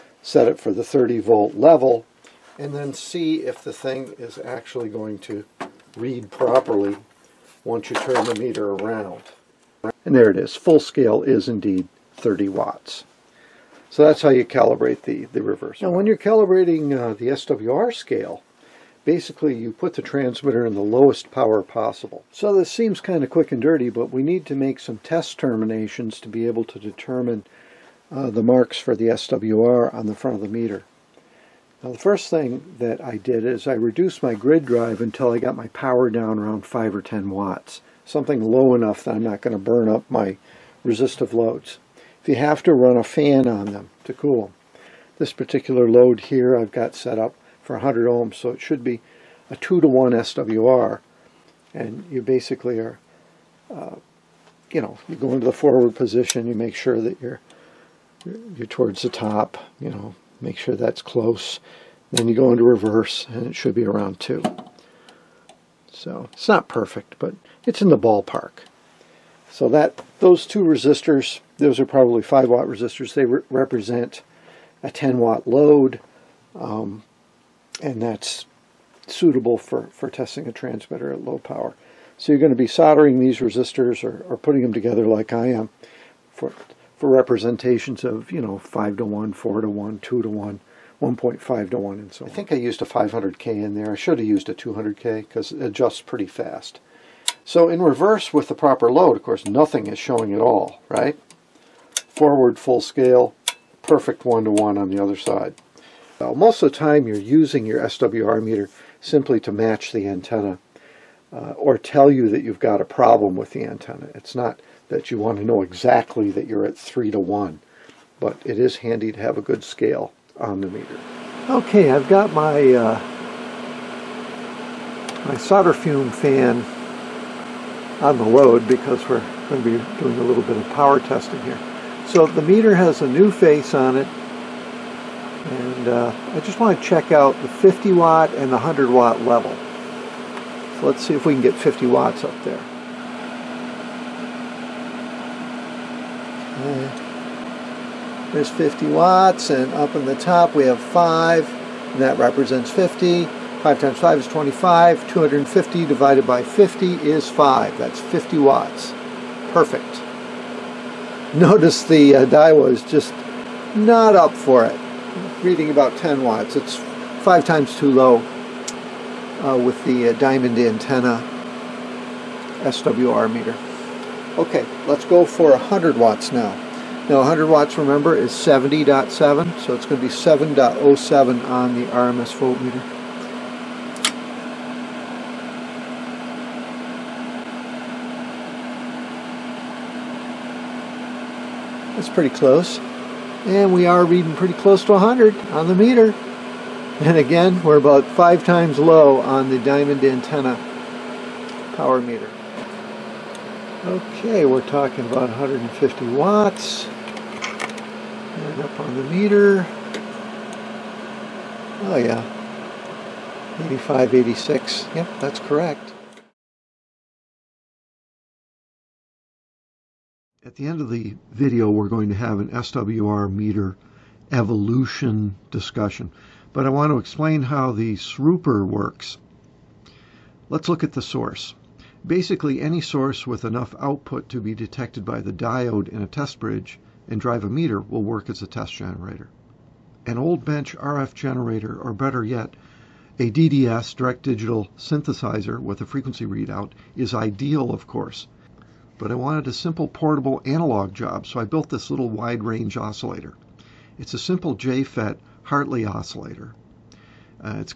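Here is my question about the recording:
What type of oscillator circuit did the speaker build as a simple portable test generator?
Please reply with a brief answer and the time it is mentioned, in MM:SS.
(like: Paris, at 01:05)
JFET Hartley oscillator, at 04:14.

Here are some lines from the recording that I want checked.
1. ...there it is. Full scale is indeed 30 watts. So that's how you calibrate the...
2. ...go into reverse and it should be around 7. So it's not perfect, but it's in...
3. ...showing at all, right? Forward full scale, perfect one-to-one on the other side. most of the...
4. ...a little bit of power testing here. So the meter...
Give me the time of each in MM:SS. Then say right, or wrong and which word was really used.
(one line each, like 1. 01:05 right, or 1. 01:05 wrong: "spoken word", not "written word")
1. 00:10 right
2. 01:02 wrong: "2", not "7"
3. 01:39 right
4. 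02:10 right.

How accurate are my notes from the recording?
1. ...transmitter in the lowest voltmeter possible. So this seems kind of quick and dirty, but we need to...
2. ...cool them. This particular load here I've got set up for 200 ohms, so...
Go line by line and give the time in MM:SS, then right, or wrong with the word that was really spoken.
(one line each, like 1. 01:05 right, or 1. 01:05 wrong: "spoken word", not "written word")
1. 00:20 wrong: "power", not "voltmeter"
2. 00:44 wrong: "100", not "200".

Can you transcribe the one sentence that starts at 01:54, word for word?
It's not that you want to know exactly that you're at 3 to 1.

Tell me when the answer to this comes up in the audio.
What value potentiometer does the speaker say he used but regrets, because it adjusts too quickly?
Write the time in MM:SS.
01:32.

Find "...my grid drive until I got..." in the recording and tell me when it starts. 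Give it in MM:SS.
00:34.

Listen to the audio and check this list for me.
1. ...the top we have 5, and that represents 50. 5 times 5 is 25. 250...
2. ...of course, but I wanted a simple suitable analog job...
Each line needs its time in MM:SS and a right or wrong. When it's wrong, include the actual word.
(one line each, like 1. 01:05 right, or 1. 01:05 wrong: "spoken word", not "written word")
1. 02:30 right
2. 04:07 wrong: "portable", not "suitable".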